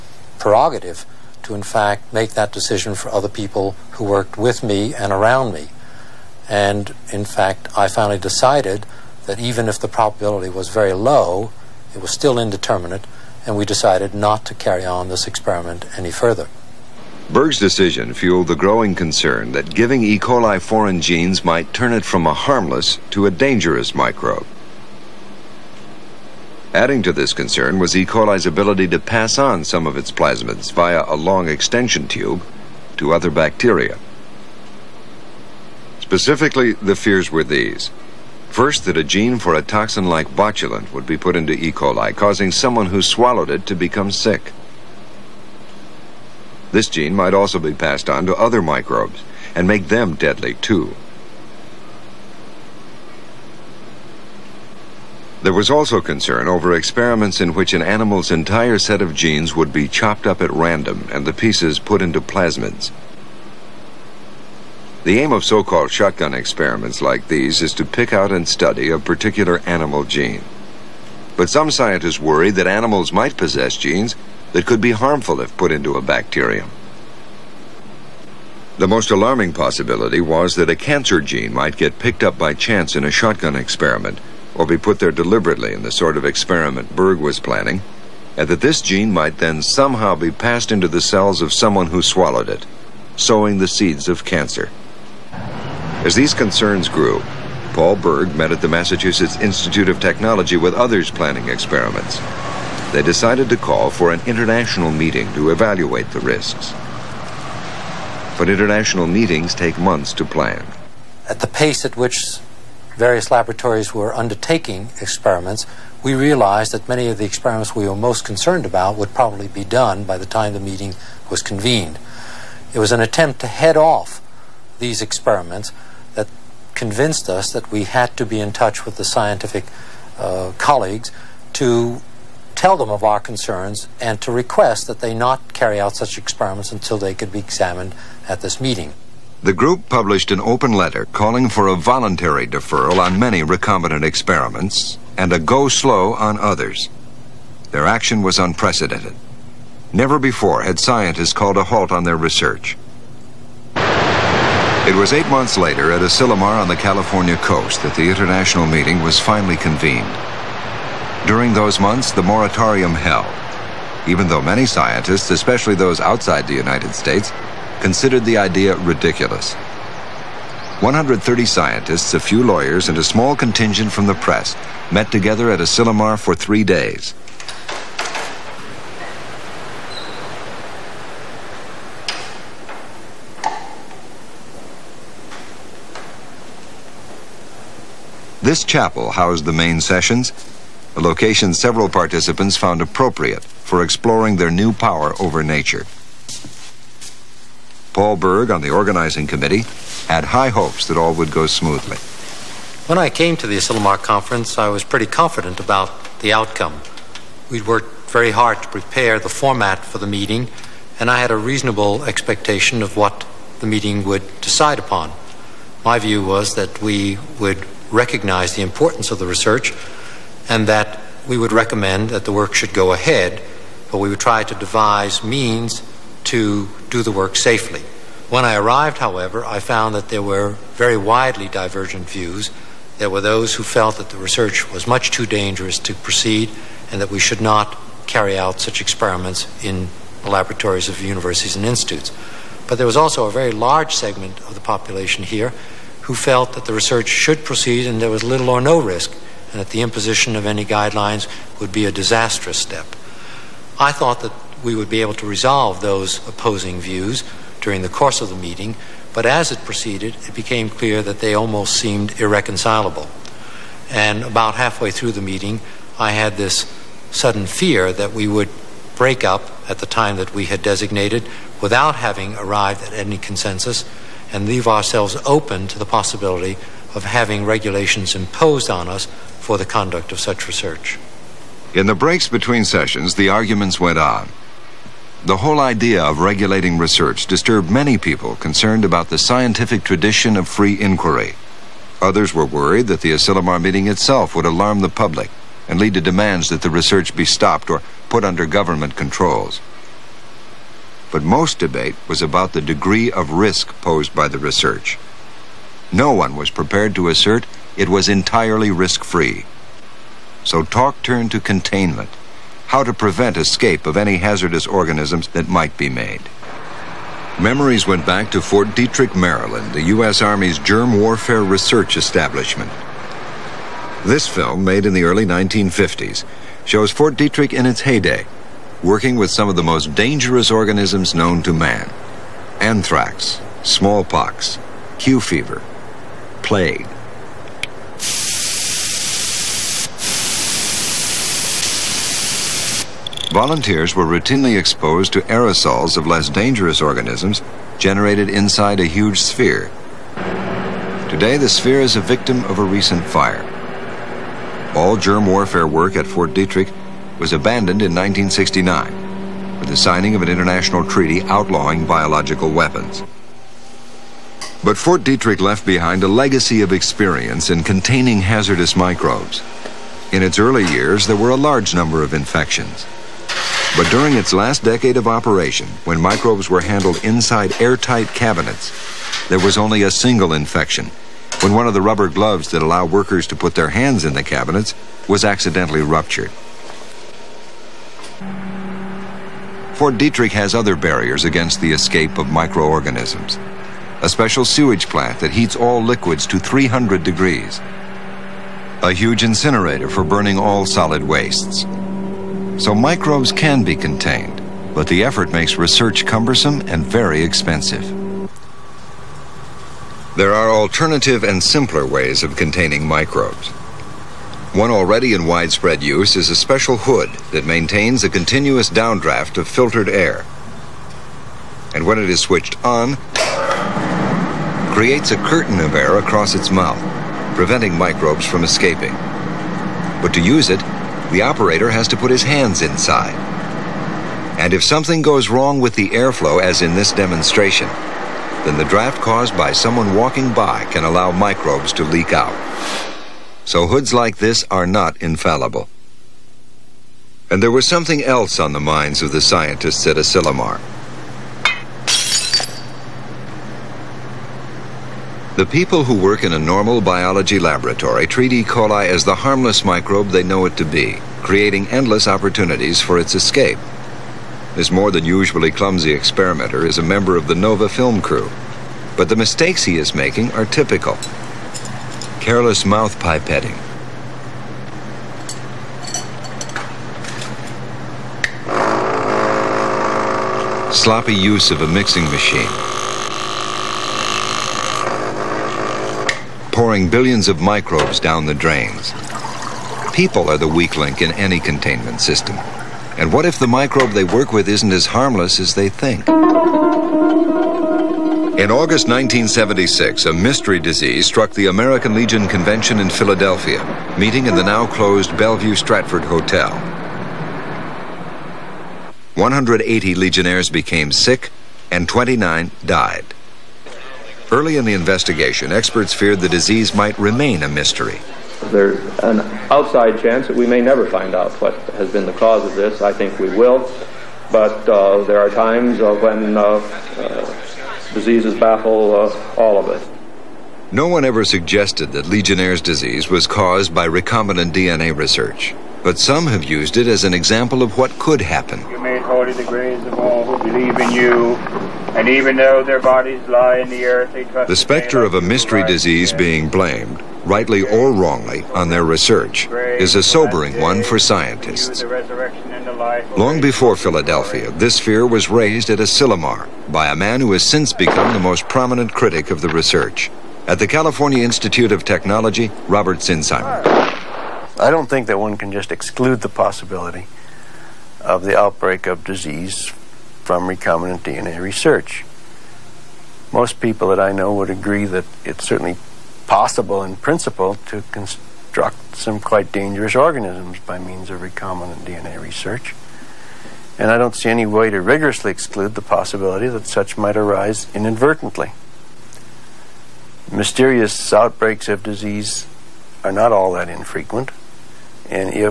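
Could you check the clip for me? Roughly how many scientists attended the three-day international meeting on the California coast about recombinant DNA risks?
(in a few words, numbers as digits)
130.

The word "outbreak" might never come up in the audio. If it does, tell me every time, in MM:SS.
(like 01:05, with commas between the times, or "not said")
09:28, 09:51.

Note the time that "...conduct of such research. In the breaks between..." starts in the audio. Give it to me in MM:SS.
04:39.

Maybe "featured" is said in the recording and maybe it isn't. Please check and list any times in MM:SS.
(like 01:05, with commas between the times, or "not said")
not said.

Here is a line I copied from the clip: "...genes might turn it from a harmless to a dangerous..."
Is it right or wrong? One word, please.
right.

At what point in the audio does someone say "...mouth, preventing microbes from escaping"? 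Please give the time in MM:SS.
07:06.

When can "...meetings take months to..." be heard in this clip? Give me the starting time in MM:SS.
01:49.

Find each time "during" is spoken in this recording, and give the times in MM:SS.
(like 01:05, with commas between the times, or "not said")
02:41, 04:17, 06:13.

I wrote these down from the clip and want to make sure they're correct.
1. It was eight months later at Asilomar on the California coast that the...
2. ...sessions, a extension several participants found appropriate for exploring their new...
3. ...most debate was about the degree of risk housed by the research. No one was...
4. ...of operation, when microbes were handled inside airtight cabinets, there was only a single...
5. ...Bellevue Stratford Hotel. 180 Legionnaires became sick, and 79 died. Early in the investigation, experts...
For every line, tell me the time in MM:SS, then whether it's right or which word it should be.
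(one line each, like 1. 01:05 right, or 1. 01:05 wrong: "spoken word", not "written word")
1. 02:34 right
2. 03:09 wrong: "location", not "extension"
3. 05:01 wrong: "posed", not "housed"
4. 06:14 right
5. 08:25 wrong: "29", not "79".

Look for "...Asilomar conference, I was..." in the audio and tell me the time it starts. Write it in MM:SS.
03:23.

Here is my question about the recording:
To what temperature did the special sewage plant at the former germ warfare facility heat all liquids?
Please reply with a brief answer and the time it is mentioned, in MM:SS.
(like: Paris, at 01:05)
300 degrees, at 06:36.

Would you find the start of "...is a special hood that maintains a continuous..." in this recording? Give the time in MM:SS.
06:56.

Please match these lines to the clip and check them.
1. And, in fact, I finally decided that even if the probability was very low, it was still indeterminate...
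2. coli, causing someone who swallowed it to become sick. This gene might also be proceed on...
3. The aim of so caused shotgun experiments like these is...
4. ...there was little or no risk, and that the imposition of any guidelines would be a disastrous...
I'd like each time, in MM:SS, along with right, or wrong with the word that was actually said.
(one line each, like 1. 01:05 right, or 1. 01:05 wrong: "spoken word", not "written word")
1. 00:06 right
2. 00:41 wrong: "passed", not "proceed"
3. 01:05 wrong: "called", not "caused"
4. 04:08 right.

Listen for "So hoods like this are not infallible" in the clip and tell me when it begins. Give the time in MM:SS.
07:23.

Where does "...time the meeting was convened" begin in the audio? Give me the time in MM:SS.
02:00.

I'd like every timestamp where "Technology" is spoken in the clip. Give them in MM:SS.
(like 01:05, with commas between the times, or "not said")
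01:40, 09:21.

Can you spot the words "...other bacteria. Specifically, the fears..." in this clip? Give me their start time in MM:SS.
00:33.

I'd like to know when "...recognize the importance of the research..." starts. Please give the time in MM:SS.
03:37.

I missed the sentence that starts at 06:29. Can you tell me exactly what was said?
Fort Detrick has other barriers against the escape of microorganisms.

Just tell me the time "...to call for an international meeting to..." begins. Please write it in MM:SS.
01:43.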